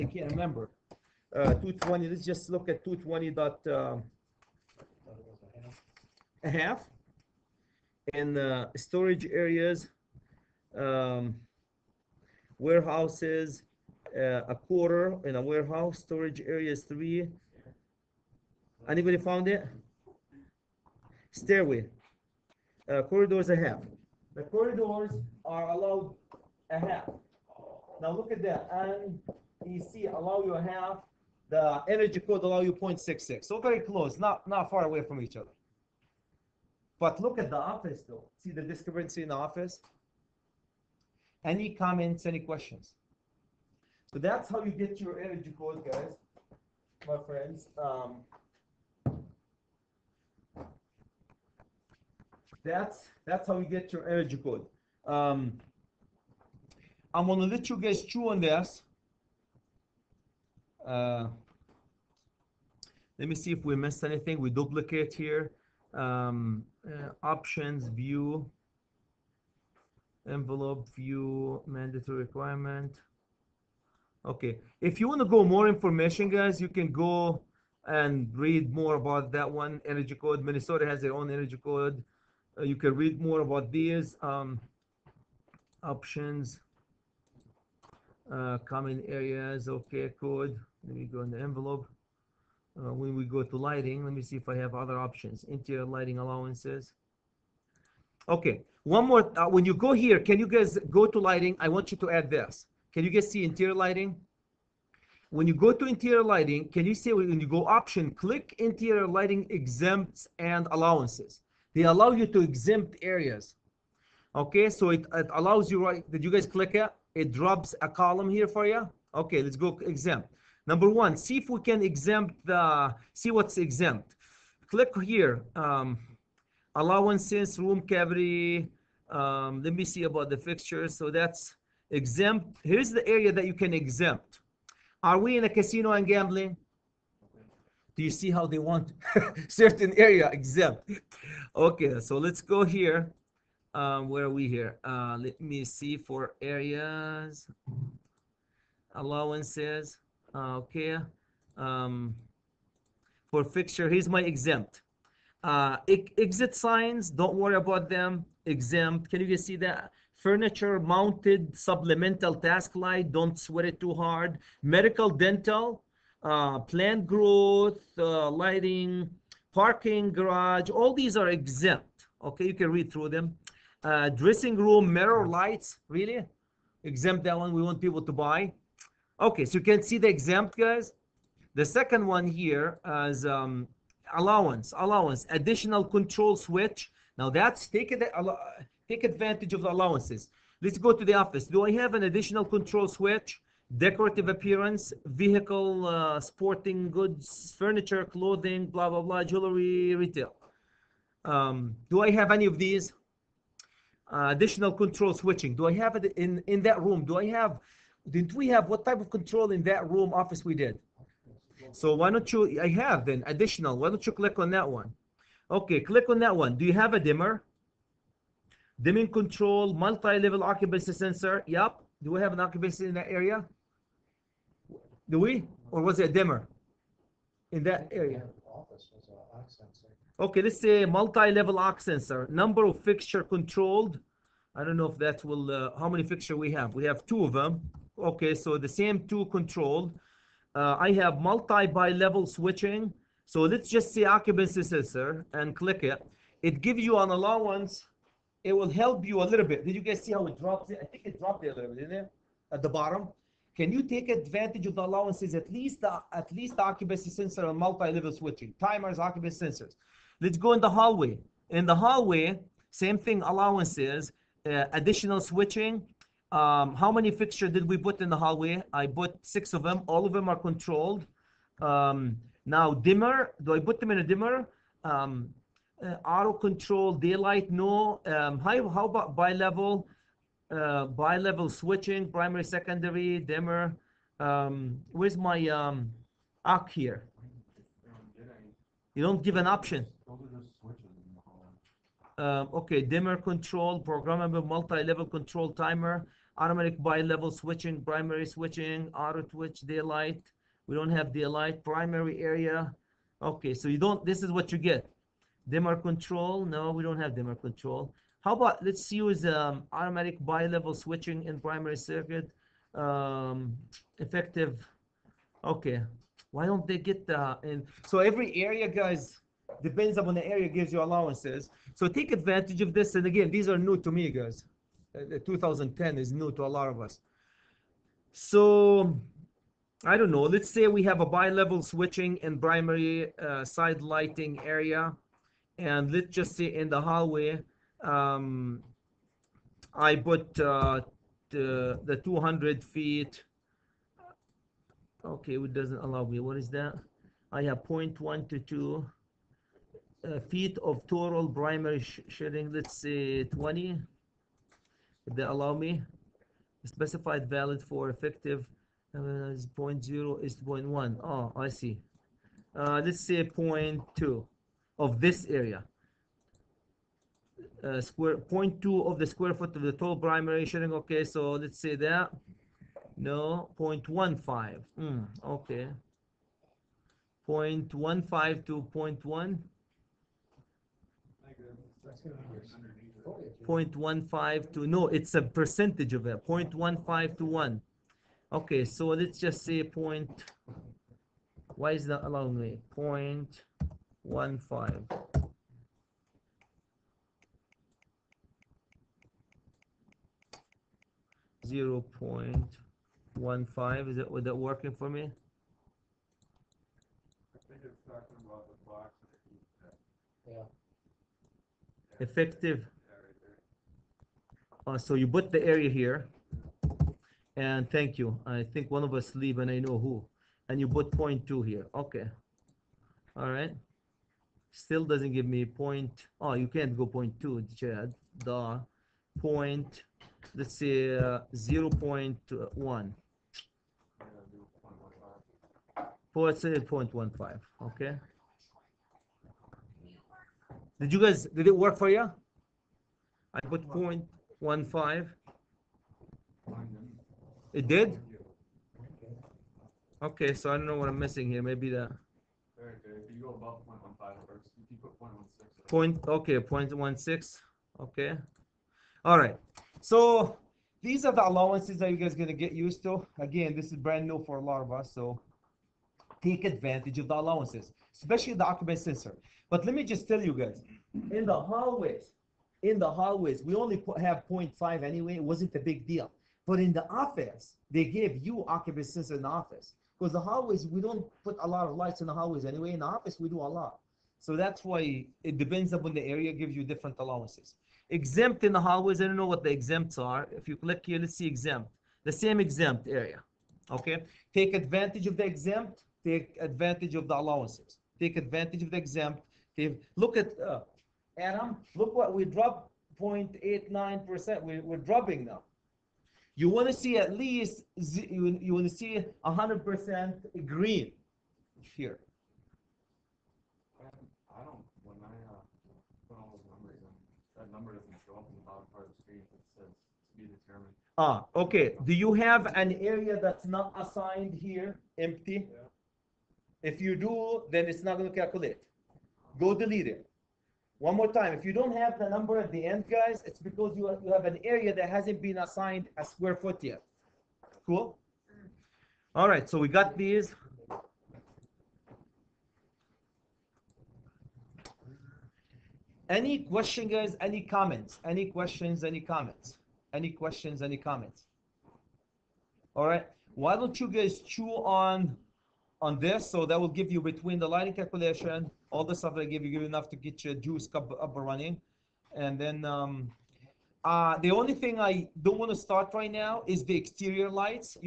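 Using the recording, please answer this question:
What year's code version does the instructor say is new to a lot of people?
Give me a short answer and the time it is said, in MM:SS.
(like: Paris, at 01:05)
2010, at 05:25.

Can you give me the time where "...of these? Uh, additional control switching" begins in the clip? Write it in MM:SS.
03:22.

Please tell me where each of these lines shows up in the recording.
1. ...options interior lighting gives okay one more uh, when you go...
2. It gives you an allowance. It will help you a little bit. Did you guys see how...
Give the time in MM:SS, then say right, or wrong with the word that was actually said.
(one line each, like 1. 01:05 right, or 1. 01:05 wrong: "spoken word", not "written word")
1. 01:34 wrong: "allowances", not "gives"
2. 04:06 right.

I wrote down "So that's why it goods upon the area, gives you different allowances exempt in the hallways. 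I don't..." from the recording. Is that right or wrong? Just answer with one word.
wrong.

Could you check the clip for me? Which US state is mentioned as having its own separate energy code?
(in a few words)
Minnesota.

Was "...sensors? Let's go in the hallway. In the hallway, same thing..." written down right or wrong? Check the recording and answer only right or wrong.
right.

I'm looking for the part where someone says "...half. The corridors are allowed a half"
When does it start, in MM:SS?
00:23.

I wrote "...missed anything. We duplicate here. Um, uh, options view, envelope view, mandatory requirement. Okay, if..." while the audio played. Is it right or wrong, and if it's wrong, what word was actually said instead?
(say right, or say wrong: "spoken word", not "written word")
right.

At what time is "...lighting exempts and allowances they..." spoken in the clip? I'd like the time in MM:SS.
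01:49.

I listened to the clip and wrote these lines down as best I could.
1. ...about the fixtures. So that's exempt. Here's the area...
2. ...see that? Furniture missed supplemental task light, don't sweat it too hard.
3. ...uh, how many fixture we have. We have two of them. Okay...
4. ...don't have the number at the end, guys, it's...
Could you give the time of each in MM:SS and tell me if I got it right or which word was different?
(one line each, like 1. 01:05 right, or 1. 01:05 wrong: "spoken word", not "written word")
1. 02:10 right
2. 02:39 wrong: "mounted", not "missed"
3. 03:55 right
4. 08:51 right.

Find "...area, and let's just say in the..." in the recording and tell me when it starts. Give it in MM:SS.
05:34.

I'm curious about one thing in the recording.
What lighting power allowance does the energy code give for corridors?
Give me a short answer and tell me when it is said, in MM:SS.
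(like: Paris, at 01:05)
0.66, at 00:32.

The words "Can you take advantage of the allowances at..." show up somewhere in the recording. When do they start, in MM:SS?
04:13.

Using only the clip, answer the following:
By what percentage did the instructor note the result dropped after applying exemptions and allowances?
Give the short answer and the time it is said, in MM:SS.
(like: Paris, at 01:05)
0.89%, at 08:23.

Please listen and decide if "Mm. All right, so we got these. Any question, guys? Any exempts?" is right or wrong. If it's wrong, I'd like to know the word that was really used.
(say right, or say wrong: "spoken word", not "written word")
wrong: "comments", not "exempts".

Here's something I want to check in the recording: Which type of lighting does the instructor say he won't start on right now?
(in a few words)
exterior lights.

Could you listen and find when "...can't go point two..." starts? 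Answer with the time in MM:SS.
07:06.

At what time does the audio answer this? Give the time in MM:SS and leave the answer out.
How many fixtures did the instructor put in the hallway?
04:29.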